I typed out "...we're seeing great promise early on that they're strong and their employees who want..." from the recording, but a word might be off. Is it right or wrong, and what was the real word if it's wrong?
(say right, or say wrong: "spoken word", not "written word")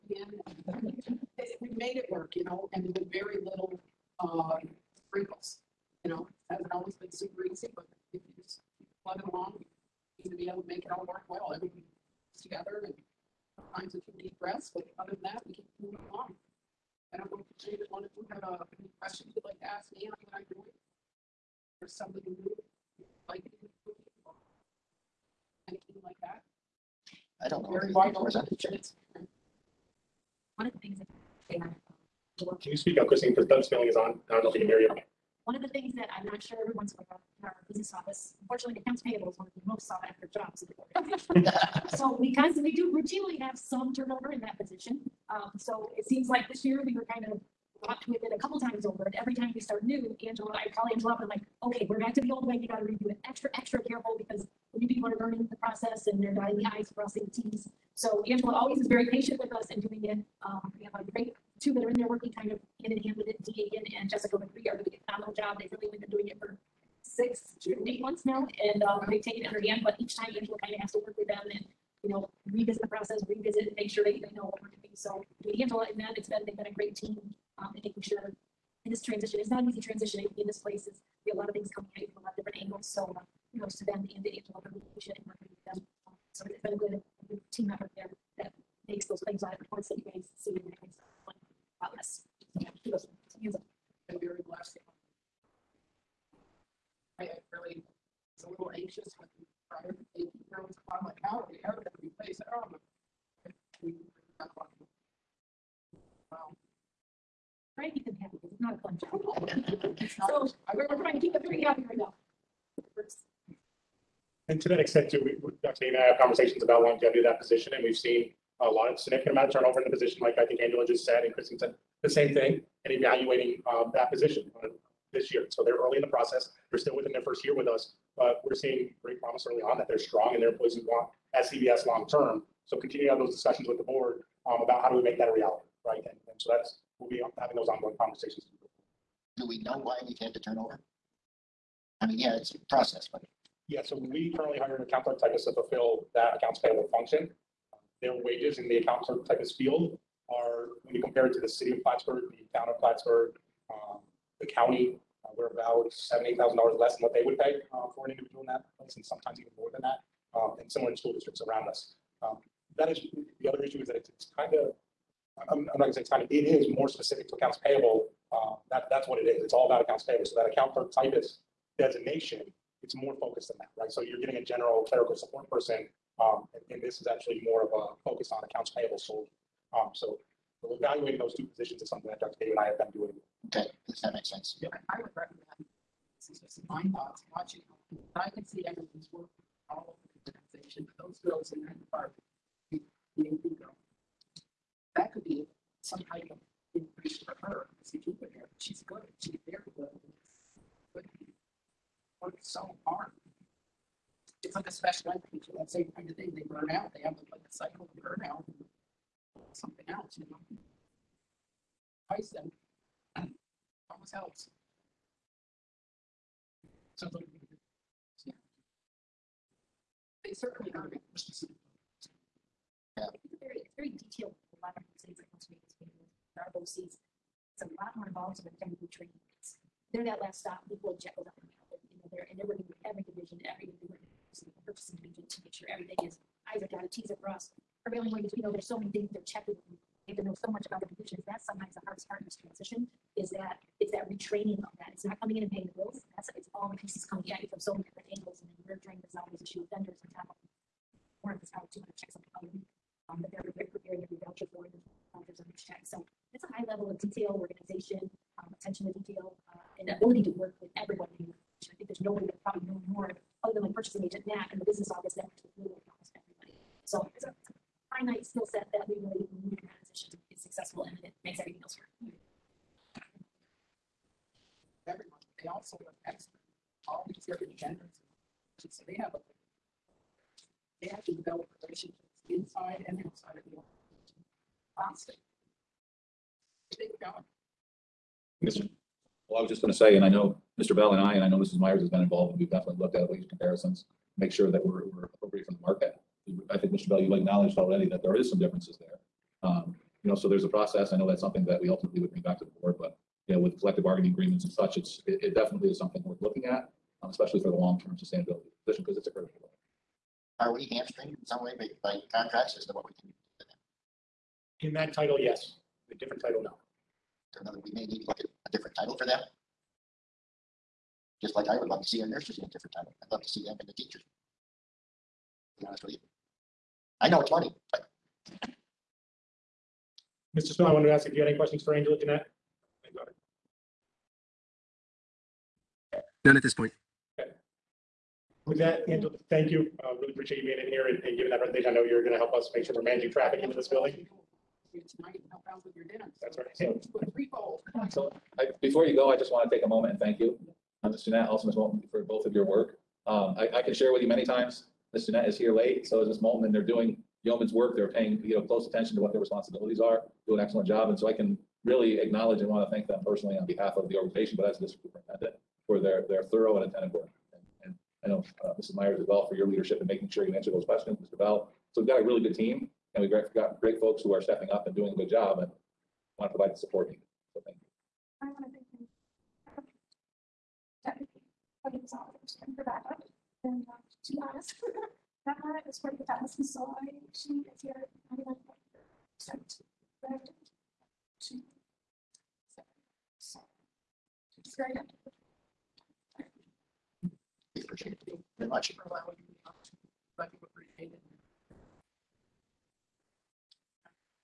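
right.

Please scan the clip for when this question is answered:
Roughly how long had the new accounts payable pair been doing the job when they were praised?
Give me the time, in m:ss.
1:07.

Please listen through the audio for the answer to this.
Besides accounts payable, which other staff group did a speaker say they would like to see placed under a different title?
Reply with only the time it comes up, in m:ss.
5:22.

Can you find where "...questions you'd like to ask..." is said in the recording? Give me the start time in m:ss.
0:19.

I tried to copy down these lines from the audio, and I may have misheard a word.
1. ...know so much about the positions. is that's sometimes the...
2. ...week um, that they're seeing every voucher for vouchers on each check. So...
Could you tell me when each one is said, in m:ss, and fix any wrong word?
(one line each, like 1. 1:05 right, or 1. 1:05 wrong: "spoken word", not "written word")
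1. 4:00 right
2. 4:12 wrong: "preparing", not "seeing".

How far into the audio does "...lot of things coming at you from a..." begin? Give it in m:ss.
1:21.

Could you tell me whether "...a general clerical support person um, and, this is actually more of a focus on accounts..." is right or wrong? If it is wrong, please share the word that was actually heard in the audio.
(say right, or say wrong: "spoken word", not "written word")
right.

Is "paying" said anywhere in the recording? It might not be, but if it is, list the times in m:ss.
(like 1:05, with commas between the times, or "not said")
4:05, 5:57.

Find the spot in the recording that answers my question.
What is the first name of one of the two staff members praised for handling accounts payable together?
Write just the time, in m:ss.
1:03.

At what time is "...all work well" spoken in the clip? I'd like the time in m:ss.
0:10.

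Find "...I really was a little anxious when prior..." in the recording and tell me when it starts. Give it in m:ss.
1:37.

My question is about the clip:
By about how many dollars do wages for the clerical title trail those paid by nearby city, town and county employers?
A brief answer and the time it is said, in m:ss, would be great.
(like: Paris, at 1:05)
$7,000-$8,000, at 2:35.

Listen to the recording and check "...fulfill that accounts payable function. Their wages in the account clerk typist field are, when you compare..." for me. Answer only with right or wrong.
right.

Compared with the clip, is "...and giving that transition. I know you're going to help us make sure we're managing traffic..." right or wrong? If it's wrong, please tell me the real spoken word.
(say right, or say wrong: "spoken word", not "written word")
wrong: "presentation", not "transition".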